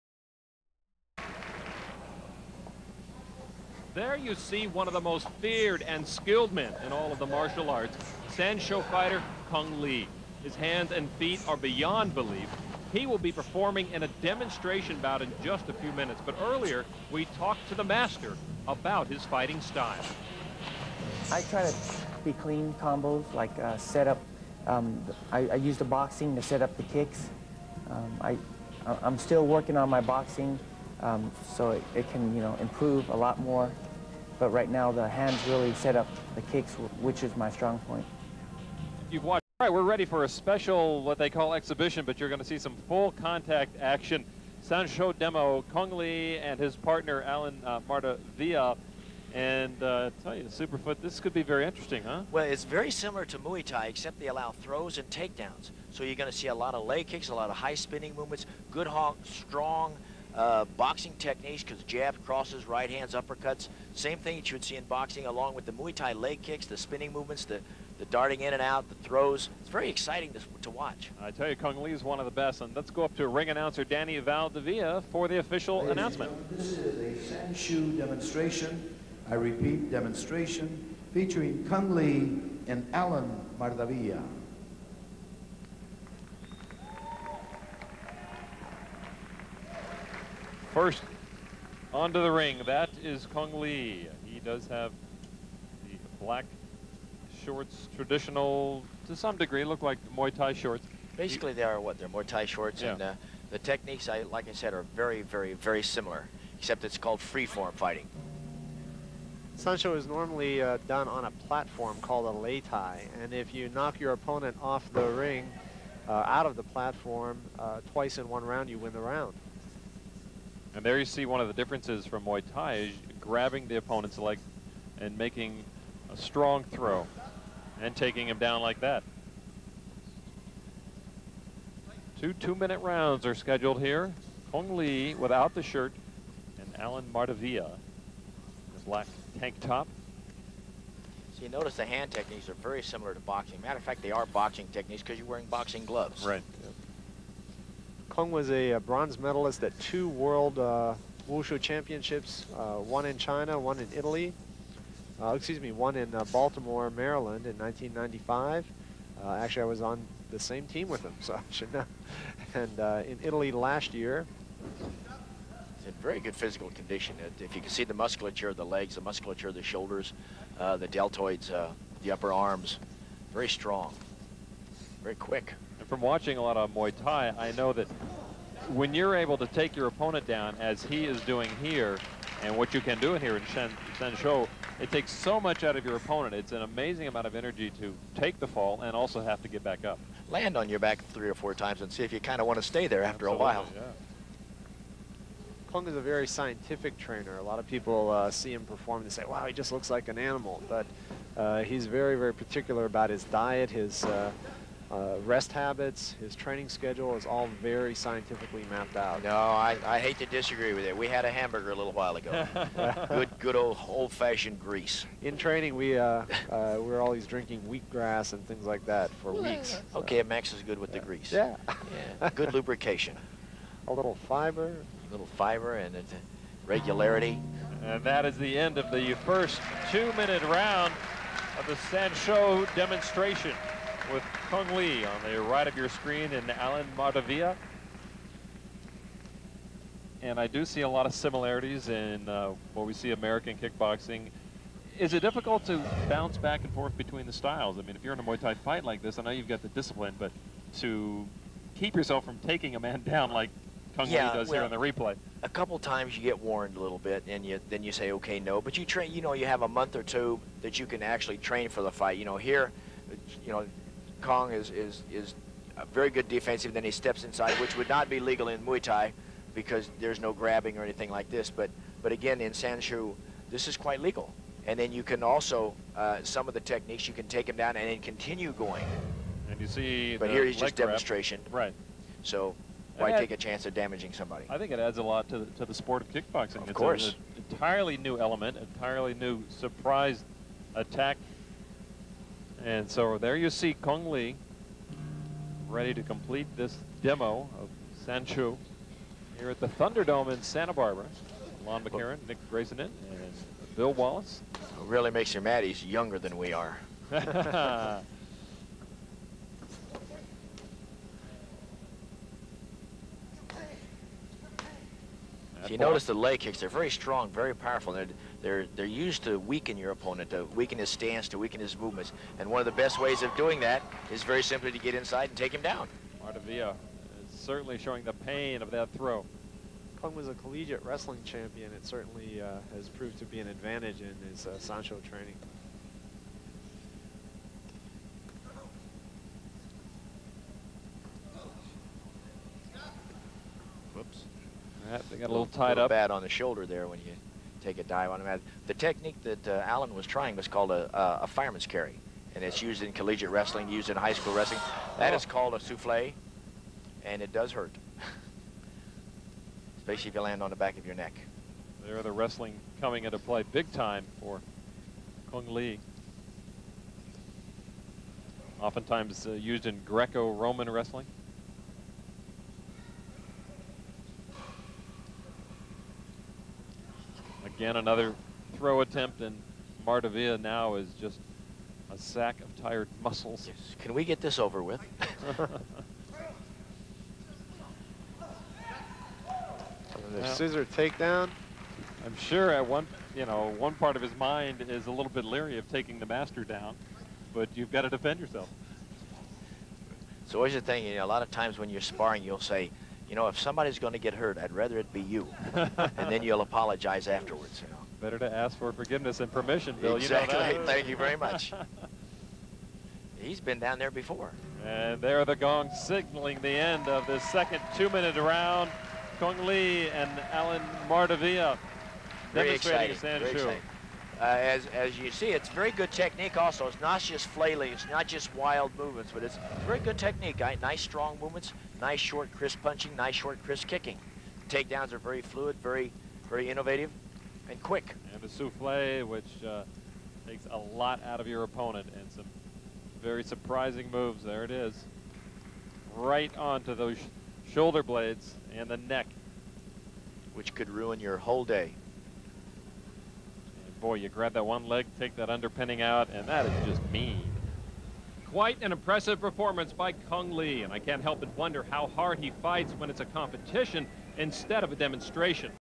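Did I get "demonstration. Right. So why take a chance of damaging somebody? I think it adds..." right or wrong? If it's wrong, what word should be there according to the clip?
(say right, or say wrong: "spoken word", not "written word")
right.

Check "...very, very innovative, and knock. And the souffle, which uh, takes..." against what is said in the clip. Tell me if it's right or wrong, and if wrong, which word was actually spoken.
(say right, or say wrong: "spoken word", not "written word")
wrong: "quick", not "knock".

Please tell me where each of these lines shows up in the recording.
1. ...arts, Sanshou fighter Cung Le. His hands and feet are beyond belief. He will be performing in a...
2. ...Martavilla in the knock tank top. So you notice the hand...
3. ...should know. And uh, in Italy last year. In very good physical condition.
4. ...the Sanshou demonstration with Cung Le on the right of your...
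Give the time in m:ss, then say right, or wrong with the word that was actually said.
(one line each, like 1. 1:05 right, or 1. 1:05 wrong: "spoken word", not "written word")
1. 0:07 right
2. 2:17 wrong: "black", not "knock"
3. 2:41 right
4. 3:51 right.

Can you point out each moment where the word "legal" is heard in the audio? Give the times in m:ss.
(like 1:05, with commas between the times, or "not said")
4:28, 4:34.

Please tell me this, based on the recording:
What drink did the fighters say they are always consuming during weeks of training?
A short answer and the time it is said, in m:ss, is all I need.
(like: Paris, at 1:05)
wheatgrass, at 3:37.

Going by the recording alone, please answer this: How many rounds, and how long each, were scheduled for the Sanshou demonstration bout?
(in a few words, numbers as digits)
Two two-minute rounds.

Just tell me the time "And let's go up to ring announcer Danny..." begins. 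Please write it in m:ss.
1:12.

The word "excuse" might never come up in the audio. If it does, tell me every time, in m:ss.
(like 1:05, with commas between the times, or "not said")
2:35.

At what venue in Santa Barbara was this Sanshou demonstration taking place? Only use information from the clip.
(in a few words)
the Thunderdome.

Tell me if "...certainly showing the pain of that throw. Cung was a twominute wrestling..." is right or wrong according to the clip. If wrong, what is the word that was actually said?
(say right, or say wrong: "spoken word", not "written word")
wrong: "collegiate", not "twominute".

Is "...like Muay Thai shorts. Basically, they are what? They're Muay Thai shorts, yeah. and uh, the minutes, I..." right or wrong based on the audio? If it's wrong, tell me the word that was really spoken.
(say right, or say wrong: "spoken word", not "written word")
wrong: "techniques", not "minutes".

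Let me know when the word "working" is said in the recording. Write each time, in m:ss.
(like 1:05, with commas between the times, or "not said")
0:29.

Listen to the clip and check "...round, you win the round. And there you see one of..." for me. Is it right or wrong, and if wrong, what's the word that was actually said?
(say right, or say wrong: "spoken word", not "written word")
right.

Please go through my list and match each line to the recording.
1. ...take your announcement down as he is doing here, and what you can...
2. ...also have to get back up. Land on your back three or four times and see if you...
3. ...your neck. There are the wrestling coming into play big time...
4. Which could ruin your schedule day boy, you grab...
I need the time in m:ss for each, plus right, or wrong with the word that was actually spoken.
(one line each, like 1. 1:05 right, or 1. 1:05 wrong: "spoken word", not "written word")
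1. 2:59 wrong: "opponent", not "announcement"
2. 3:08 right
3. 6:00 right
4. 7:30 wrong: "whole", not "schedule".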